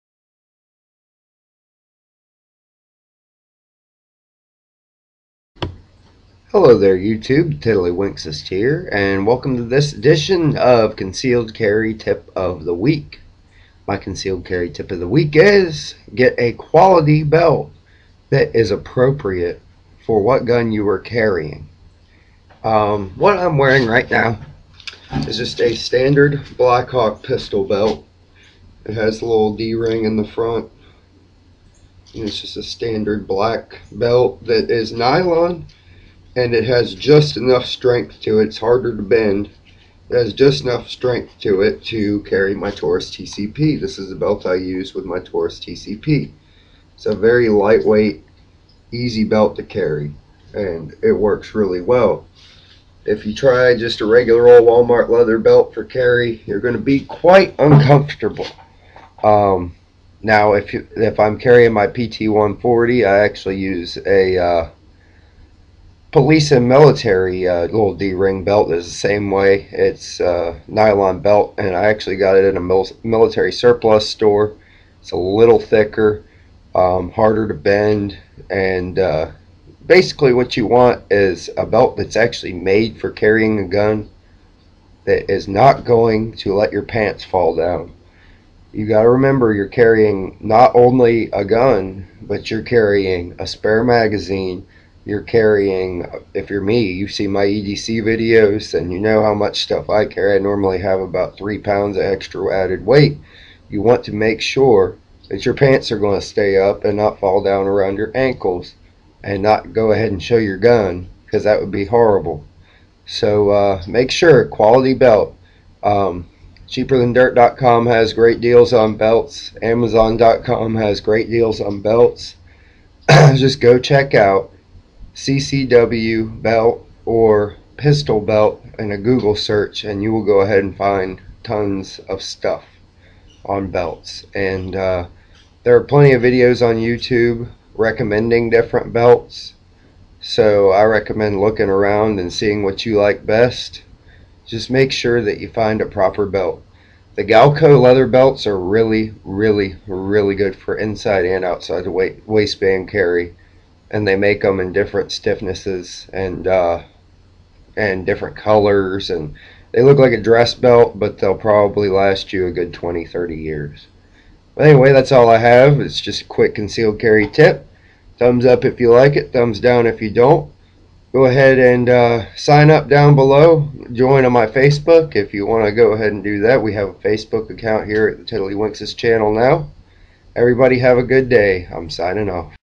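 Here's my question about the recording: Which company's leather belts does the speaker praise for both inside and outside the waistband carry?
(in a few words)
Galco.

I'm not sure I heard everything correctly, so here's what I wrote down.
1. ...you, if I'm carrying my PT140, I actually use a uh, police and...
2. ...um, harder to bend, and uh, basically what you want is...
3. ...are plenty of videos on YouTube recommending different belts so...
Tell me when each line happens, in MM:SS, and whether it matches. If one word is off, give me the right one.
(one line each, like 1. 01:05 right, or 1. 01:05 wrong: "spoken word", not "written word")
1. 01:00 right
2. 01:16 right
3. 02:15 right.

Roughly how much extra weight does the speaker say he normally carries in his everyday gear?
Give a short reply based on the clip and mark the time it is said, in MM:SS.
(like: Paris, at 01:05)
3 pounds, at 01:41.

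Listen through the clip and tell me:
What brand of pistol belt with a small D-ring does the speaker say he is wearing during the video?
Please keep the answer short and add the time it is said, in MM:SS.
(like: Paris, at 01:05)
Blackhawk, at 00:26.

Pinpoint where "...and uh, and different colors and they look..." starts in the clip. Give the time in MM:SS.
02:36.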